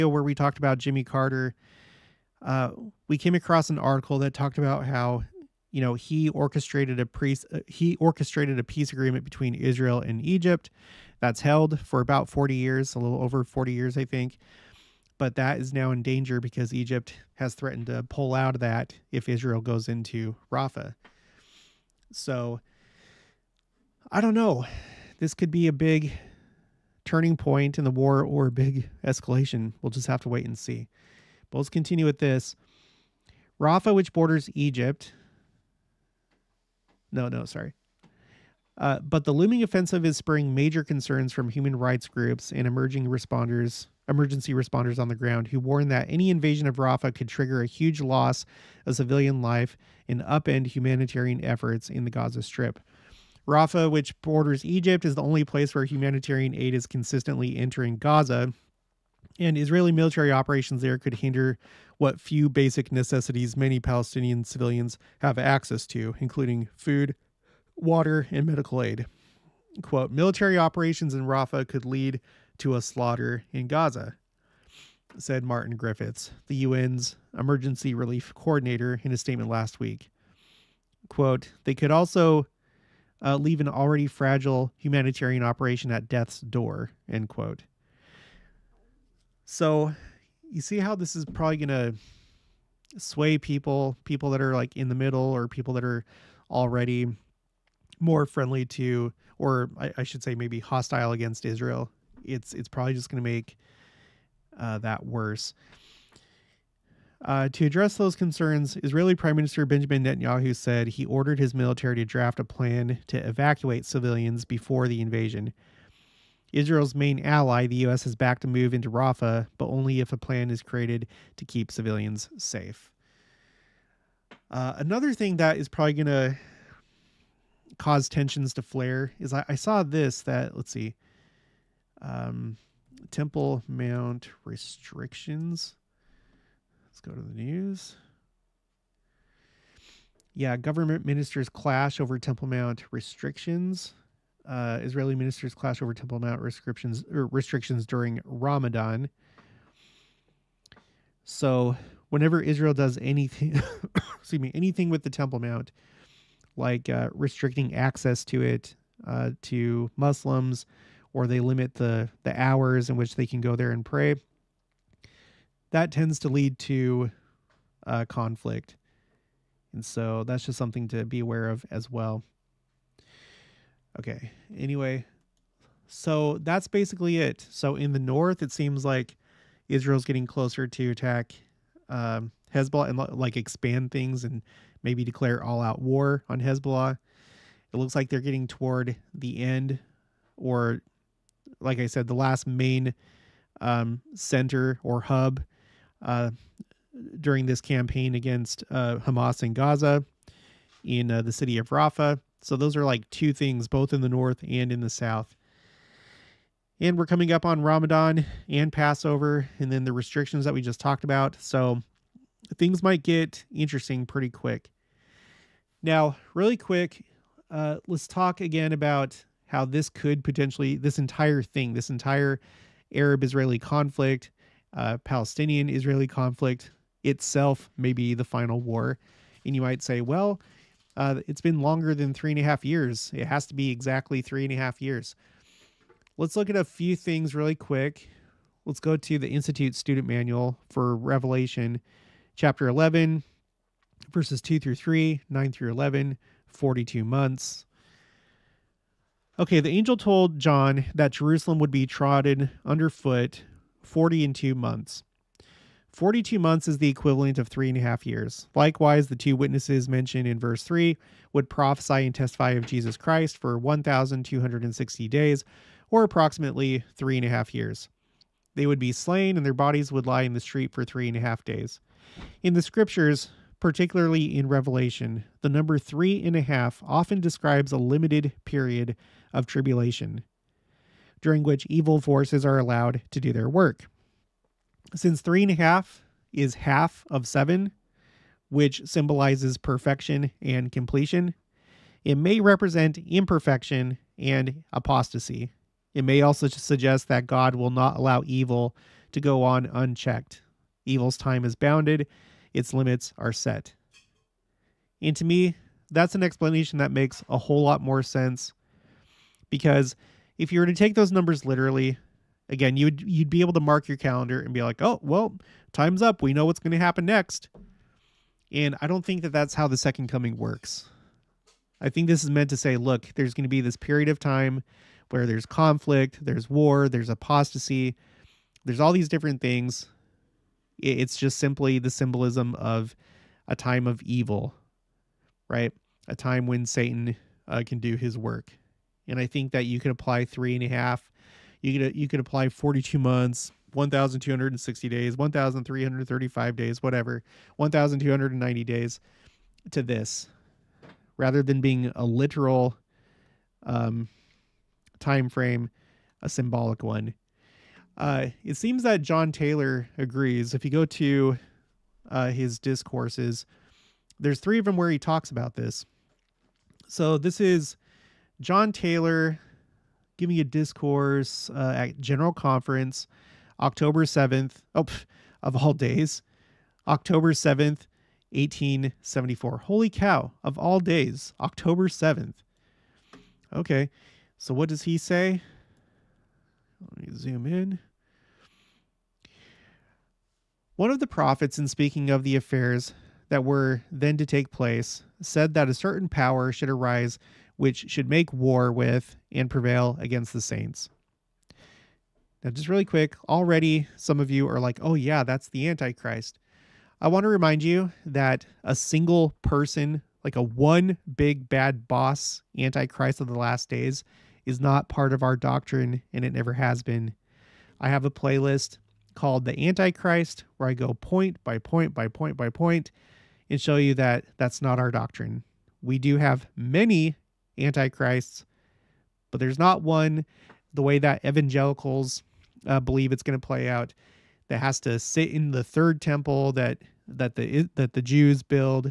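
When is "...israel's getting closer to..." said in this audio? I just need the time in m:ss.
2:59.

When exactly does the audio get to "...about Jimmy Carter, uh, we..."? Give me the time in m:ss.
0:00.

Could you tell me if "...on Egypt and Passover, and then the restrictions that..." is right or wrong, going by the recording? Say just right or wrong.
wrong.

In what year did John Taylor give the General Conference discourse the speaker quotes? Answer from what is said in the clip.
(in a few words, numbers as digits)
1874.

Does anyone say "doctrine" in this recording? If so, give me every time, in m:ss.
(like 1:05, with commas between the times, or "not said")
6:55, 7:04.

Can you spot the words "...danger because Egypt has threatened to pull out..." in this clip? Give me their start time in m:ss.
0:16.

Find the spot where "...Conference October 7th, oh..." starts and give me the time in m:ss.
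6:12.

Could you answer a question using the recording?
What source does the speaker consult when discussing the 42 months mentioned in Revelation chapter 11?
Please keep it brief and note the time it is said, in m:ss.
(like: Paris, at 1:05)
Institute Student Manual, at 3:59.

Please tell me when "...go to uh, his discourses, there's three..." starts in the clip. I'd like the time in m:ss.
6:00.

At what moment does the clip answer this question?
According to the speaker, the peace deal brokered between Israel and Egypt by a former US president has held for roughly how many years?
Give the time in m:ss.
0:11.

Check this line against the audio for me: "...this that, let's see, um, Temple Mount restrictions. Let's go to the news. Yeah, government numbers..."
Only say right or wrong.
wrong.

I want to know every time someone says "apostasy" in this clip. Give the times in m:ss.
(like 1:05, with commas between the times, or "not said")
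4:54, 5:27.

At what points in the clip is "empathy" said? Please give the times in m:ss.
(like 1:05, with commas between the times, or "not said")
not said.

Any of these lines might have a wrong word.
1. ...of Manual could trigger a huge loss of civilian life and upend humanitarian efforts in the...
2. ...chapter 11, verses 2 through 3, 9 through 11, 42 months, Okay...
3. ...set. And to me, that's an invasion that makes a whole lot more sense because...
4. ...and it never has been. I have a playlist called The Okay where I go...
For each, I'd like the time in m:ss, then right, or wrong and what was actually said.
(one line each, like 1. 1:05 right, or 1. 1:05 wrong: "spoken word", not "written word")
1. 0:46 wrong: "Rafah", not "Manual"
2. 4:02 right
3. 5:03 wrong: "explanation", not "invasion"
4. 6:56 wrong: "Antichrist", not "Okay".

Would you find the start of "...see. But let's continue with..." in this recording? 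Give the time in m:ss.
0:30.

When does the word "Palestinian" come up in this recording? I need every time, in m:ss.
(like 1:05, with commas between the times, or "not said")
1:03, 3:45.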